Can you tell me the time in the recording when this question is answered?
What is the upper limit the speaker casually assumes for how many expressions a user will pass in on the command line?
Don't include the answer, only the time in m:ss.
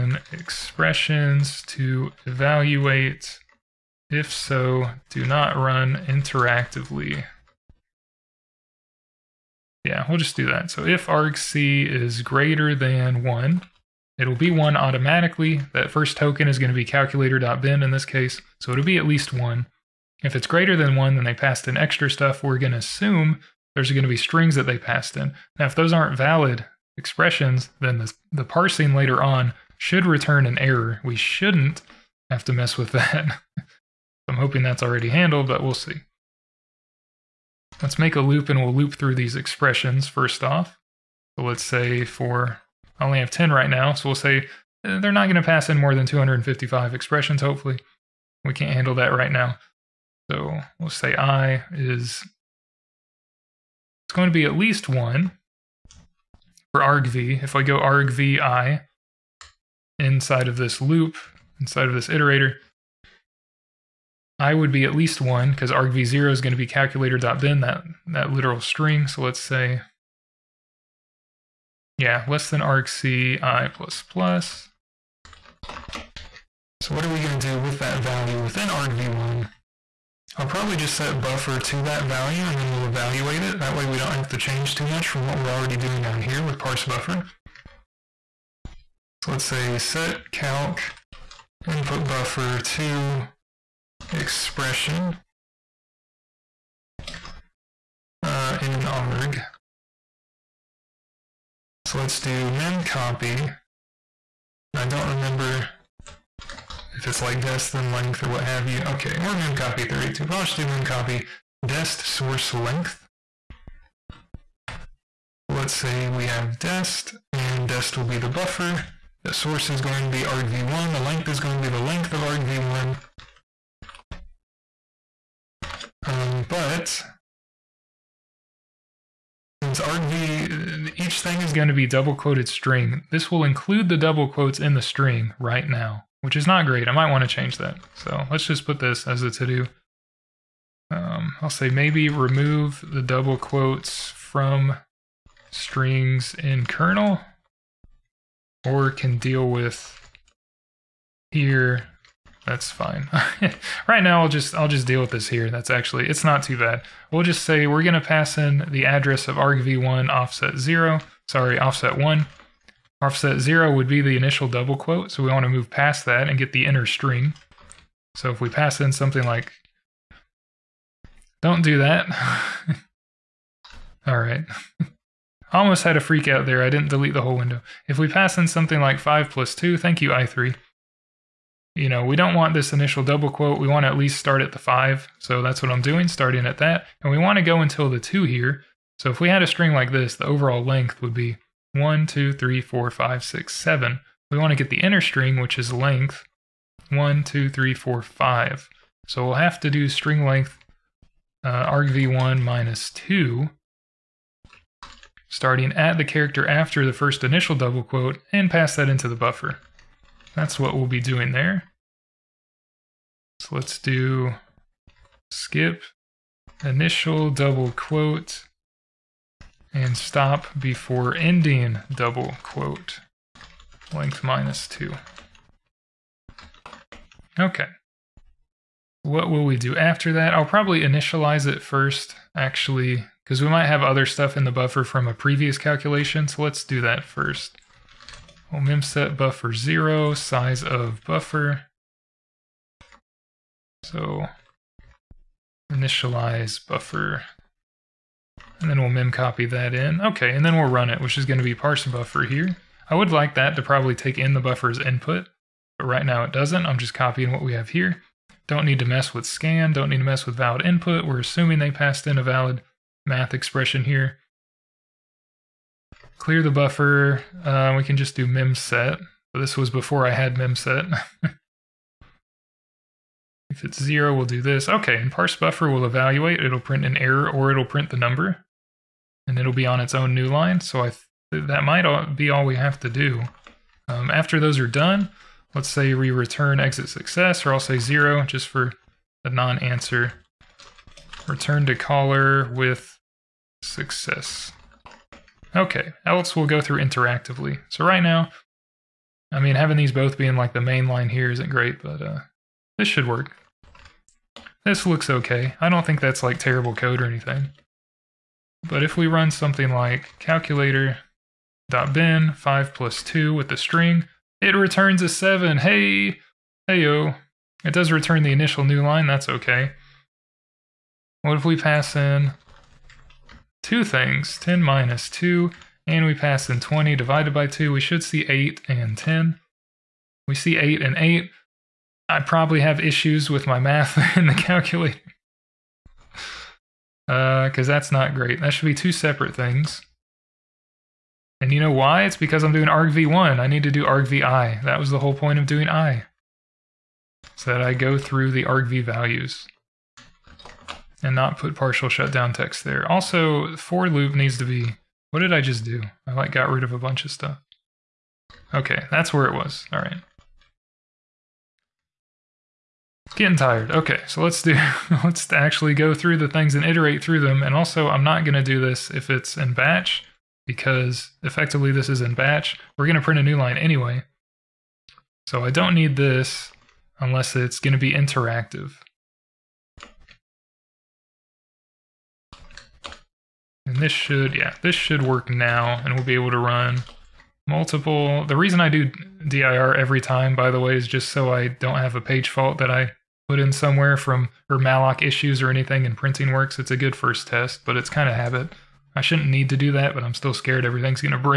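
0:46.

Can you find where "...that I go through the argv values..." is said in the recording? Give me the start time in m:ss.
5:47.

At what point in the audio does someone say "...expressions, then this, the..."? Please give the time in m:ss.
0:26.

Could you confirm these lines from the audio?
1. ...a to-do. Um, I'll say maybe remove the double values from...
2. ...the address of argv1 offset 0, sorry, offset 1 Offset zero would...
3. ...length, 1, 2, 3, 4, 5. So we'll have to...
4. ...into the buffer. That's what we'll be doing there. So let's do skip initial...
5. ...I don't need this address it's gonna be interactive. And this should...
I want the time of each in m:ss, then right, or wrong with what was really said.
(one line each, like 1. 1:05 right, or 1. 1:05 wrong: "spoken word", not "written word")
1. 2:19 wrong: "quotes", not "values"
2. 2:38 right
3. 3:15 right
4. 3:28 right
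5. 6:15 wrong: "unless", not "address".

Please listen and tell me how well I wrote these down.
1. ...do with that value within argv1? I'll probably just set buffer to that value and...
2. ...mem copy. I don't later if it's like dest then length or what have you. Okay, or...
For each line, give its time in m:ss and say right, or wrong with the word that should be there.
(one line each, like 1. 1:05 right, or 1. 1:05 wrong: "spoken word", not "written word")
1. 1:17 right
2. 1:42 wrong: "remember", not "later".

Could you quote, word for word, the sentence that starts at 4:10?
Okay, and then we'll run it, which is going to be parse buffer here.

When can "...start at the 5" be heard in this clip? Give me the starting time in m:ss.
3:04.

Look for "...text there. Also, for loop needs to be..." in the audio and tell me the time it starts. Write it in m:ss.
5:52.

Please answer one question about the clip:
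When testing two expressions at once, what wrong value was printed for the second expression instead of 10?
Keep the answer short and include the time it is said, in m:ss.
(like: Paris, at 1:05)
8, at 5:30.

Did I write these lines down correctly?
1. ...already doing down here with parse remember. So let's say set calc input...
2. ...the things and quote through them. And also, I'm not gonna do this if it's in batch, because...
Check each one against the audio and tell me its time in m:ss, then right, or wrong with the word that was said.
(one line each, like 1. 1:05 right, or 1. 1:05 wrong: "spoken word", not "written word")
1. 1:25 wrong: "buffer", not "remember"
2. 6:06 wrong: "iterate", not "quote".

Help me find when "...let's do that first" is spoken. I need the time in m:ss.
3:56.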